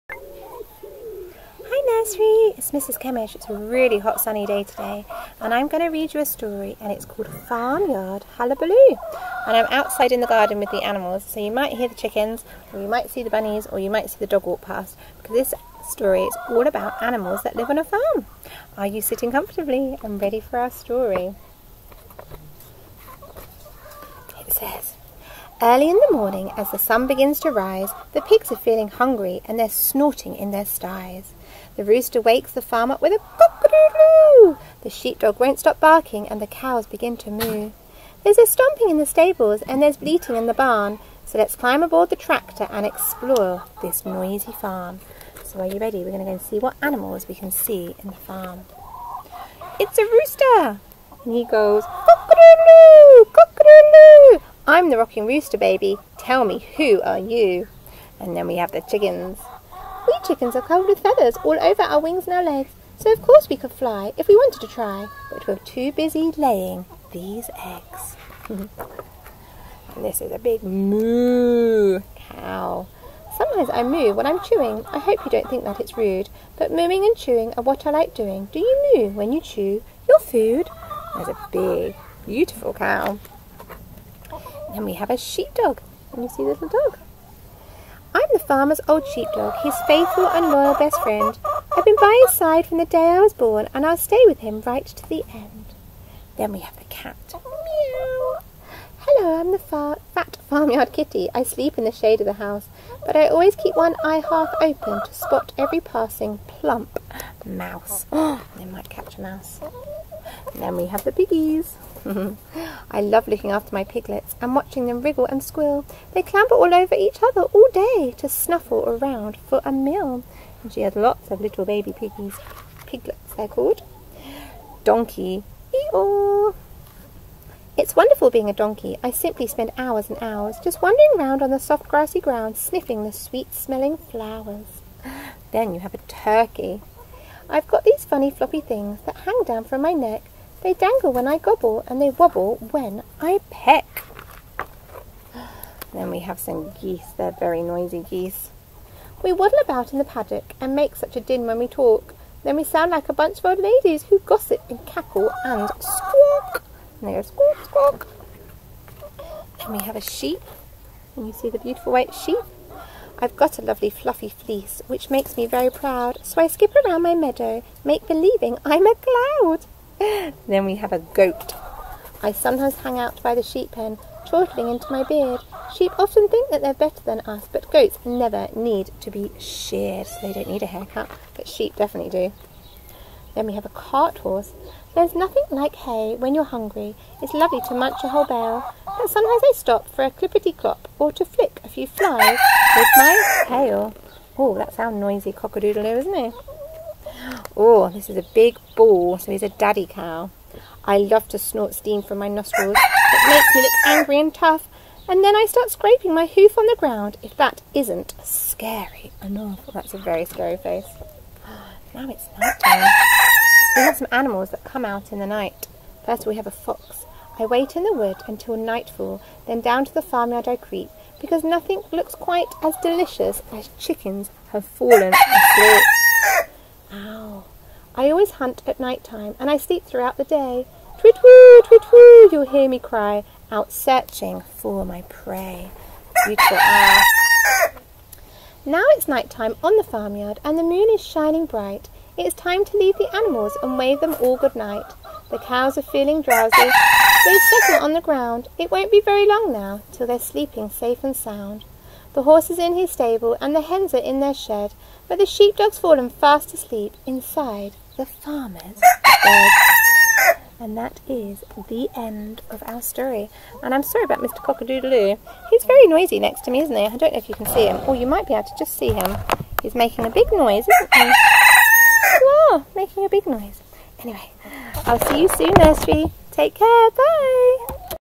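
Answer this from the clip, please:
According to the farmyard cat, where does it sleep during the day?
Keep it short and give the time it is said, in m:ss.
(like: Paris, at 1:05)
in the shade of the house, at 1:41.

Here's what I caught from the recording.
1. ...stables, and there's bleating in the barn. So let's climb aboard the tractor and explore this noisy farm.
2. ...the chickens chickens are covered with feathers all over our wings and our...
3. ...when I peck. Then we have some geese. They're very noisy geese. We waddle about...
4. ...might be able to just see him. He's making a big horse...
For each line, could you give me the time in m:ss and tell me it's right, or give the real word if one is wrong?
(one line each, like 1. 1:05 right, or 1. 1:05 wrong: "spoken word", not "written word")
1. 0:39 right
2. 0:58 right
3. 2:22 right
4. 4:28 wrong: "noise", not "horse".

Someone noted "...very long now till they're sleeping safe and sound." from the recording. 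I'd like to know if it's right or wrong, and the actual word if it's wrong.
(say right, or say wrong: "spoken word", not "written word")
right.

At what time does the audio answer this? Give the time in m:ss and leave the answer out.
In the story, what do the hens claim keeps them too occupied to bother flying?
1:06.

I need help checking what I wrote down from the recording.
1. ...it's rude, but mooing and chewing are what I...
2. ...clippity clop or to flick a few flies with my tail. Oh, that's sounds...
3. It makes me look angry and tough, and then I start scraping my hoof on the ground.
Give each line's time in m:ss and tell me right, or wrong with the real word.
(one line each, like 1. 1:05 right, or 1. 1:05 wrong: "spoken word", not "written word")
1. 1:15 right
2. 3:10 right
3. 3:22 right.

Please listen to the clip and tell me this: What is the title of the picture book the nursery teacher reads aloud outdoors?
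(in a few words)
Farmyard Hullabaloo.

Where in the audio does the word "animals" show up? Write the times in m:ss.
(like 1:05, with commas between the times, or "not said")
0:10, 0:17, 0:46, 3:34, 4:03.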